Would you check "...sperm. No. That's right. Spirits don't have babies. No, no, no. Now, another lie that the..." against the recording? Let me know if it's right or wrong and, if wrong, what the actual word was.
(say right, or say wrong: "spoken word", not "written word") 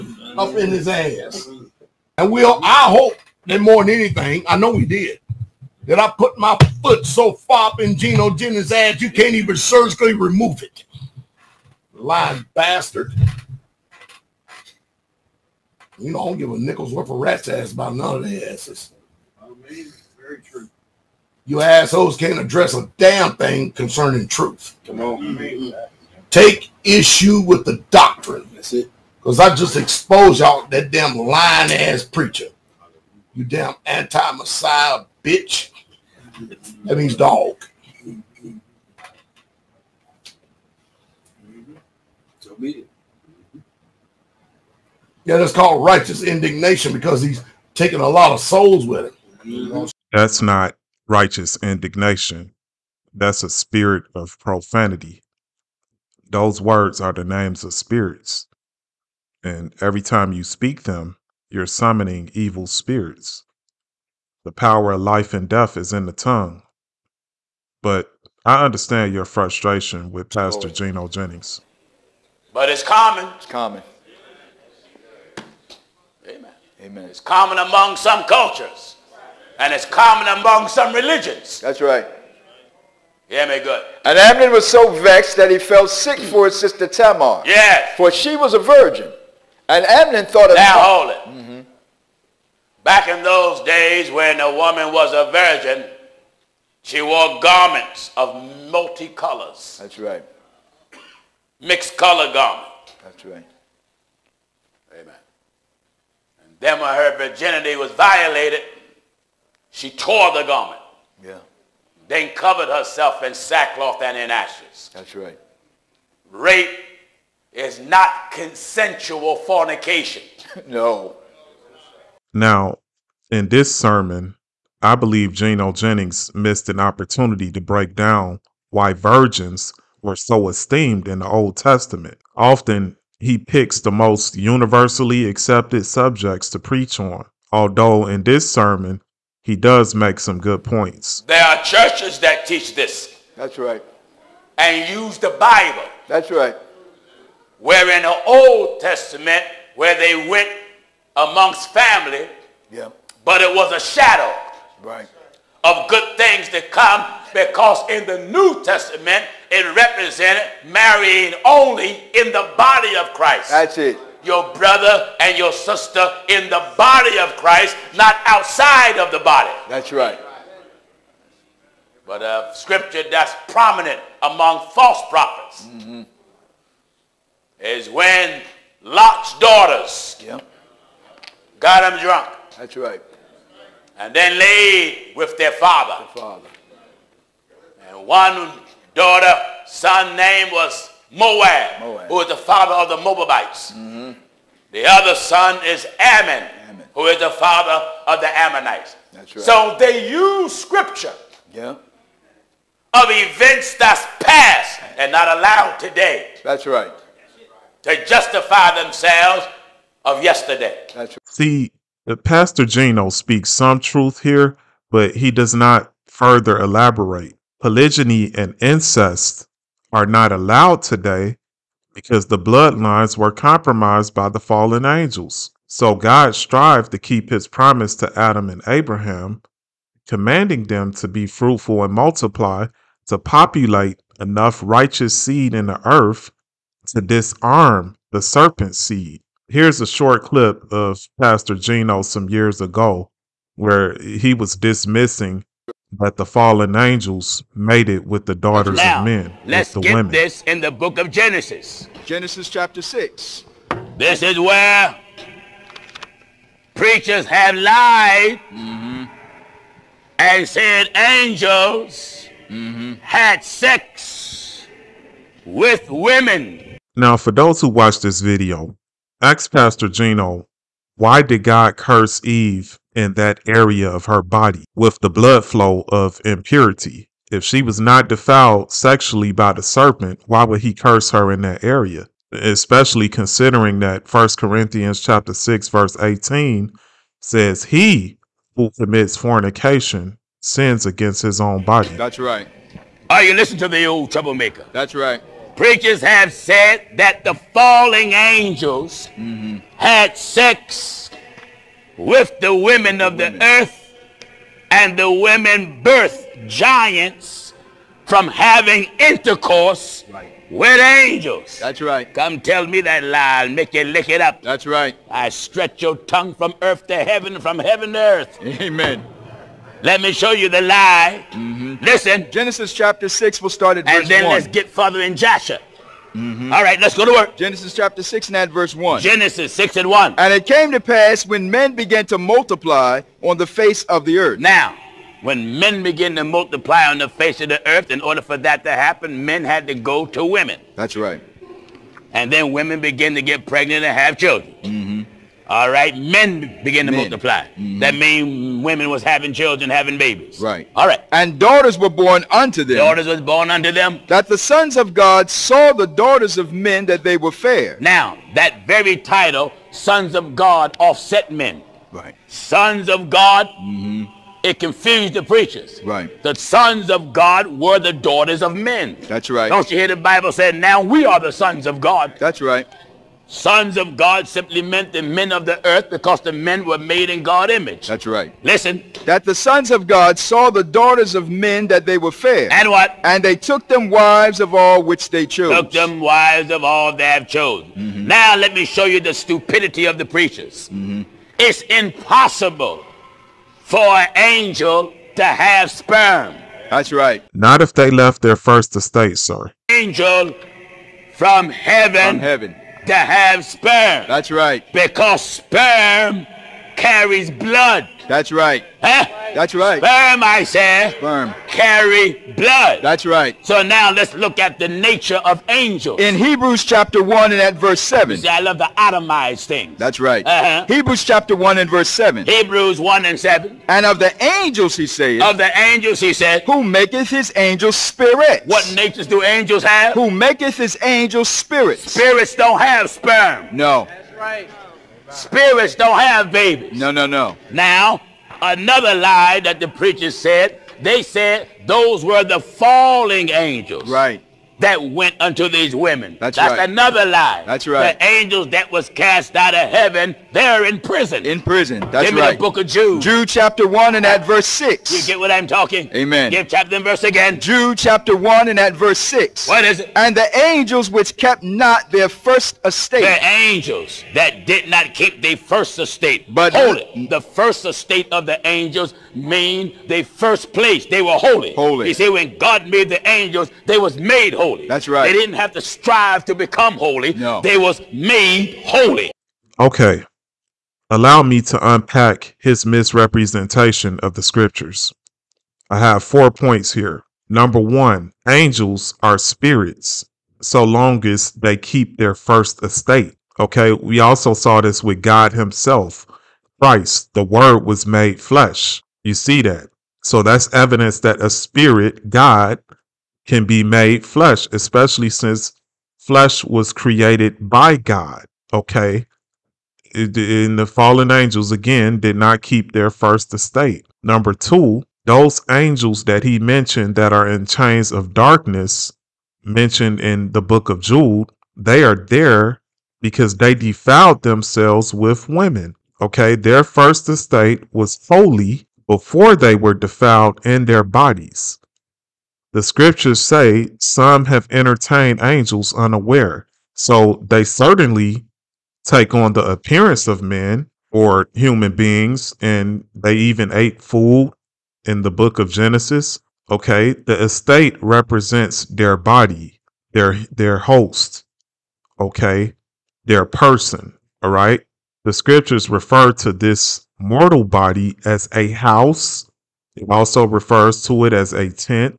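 right.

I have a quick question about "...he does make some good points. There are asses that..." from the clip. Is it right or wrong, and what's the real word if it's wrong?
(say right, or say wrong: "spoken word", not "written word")
wrong: "churches", not "asses".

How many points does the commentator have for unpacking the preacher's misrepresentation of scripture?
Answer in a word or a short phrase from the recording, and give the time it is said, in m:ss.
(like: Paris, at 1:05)
4, at 8:06.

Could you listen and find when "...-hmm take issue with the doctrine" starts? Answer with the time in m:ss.
0:25.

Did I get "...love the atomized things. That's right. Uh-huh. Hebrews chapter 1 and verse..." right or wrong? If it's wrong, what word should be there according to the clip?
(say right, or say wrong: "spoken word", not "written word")
right.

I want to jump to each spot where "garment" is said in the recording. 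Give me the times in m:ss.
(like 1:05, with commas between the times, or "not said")
1:37, 1:42, 1:50.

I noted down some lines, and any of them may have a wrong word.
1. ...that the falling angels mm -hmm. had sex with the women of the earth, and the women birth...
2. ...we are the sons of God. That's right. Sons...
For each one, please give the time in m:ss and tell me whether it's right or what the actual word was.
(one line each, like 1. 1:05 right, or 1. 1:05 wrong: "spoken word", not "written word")
1. 4:56 right
2. 6:10 right.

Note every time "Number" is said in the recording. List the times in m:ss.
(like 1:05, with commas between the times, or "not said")
8:07, 8:34.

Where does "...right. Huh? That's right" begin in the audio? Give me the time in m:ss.
6:48.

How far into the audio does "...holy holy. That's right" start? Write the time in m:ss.
7:54.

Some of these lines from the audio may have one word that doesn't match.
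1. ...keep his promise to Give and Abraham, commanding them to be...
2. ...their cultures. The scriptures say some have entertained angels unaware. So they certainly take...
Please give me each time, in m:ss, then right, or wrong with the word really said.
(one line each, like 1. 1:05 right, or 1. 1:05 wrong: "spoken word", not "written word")
1. 3:46 wrong: "Adam", not "Give"
2. 8:50 wrong: "bodies", not "cultures".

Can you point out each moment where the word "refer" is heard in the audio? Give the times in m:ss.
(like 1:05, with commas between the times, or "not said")
9:15, 9:20.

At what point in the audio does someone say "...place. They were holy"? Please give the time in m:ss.
7:50.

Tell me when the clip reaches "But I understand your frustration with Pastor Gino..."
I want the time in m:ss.
1:07.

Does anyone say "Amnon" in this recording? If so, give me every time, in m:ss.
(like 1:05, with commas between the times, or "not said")
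1:24, 1:29.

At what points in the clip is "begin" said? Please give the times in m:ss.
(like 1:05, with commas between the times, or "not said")
5:35, 5:42.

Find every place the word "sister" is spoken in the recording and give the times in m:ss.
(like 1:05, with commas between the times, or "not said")
1:26, 2:45.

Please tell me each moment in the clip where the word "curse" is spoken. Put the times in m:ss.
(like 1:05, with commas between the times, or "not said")
4:31, 4:40.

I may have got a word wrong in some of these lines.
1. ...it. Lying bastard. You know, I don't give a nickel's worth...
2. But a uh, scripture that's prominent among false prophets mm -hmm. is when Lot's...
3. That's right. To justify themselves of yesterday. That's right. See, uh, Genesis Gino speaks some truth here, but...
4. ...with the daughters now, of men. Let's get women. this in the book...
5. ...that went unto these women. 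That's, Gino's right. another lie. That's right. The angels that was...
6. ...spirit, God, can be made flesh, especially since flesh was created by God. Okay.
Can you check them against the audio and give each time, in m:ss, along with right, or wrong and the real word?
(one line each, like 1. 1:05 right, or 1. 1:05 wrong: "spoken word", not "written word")
1. 0:10 right
2. 2:52 right
3. 3:26 wrong: "Pastor", not "Genesis"
4. 4:08 right
5. 7:24 wrong: "That", not "Gino"
6. 8:21 right.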